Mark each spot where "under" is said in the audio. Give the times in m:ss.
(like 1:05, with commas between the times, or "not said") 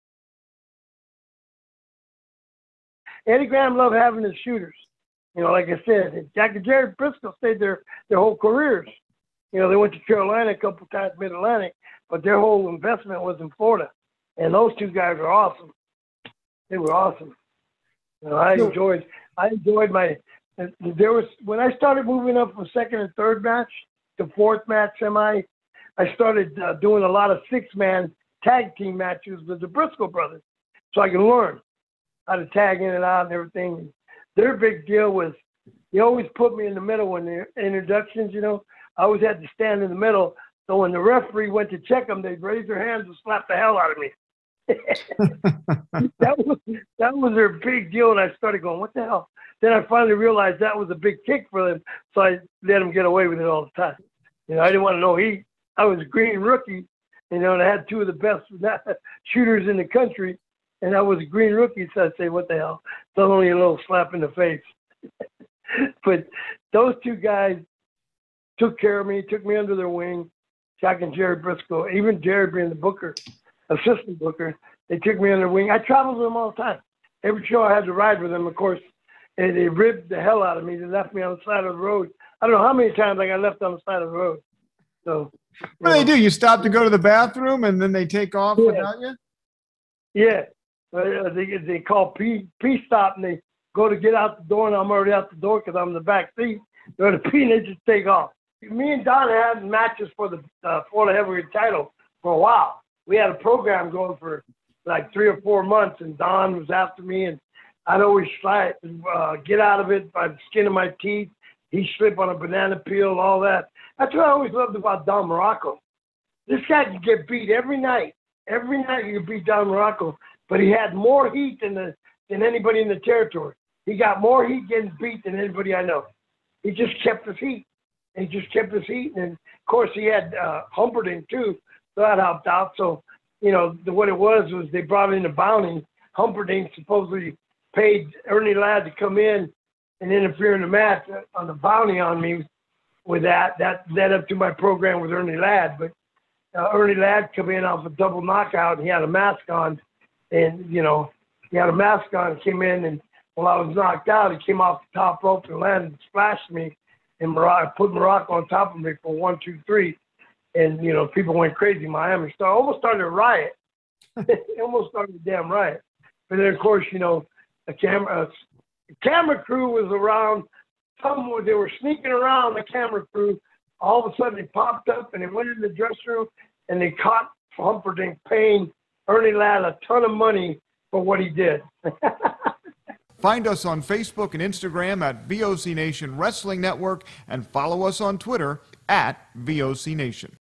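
1:09, 1:15.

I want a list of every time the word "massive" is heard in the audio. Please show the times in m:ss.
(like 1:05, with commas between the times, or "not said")
not said.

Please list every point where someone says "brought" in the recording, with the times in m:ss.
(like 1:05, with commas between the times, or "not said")
2:14.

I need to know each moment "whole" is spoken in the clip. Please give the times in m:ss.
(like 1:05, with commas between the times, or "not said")
0:08, 0:12.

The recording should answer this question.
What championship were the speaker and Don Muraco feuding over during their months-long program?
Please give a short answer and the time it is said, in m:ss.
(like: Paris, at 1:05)
Florida heavyweight title, at 1:40.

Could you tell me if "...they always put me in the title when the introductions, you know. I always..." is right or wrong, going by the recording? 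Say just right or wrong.
wrong.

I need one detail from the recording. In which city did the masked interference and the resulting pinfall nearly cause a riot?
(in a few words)
Miami.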